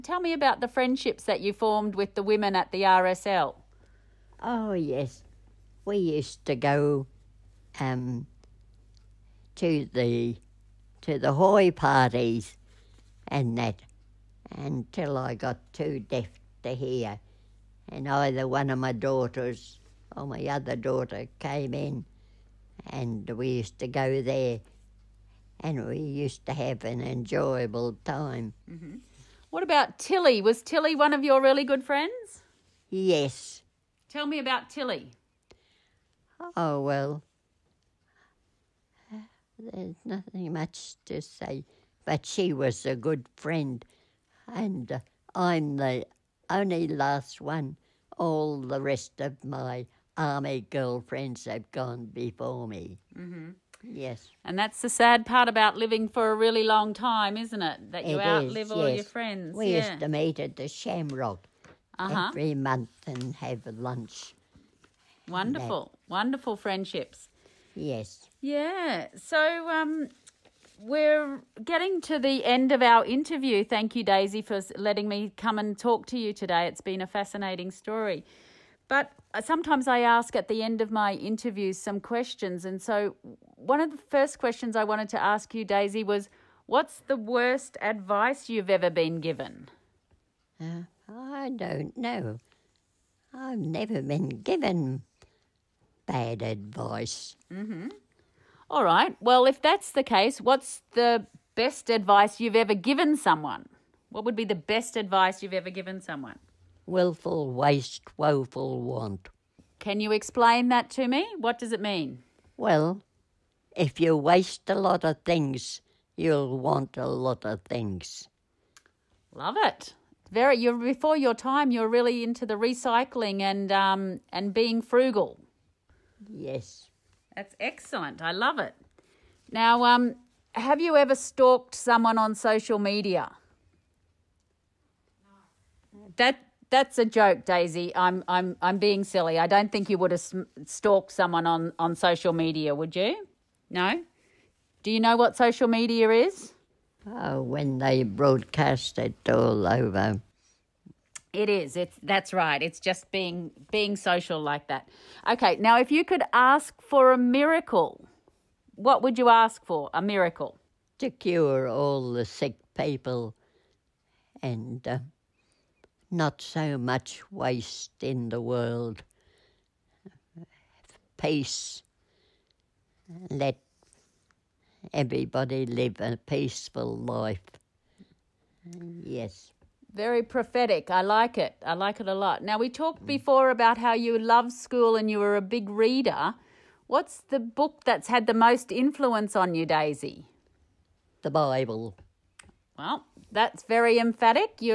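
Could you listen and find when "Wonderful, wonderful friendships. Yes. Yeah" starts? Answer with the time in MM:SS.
01:05.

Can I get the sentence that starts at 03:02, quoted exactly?
Now, we talked before about how you loved school and you were a big reader.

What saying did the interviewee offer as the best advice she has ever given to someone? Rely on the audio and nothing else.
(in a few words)
Willful waste, woeful want.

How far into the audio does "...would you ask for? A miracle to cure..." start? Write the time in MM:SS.
02:39.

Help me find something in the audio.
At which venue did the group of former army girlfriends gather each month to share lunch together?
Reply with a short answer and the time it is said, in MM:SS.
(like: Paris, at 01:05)
The Shamrock, at 01:00.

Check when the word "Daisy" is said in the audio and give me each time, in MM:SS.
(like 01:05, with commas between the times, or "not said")
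01:14, 01:25, 02:17, 03:09.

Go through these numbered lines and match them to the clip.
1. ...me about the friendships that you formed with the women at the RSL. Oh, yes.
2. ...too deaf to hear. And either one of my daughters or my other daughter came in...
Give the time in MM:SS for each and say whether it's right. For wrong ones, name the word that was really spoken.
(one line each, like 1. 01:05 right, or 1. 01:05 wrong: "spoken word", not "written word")
1. 00:00 right
2. 00:15 right.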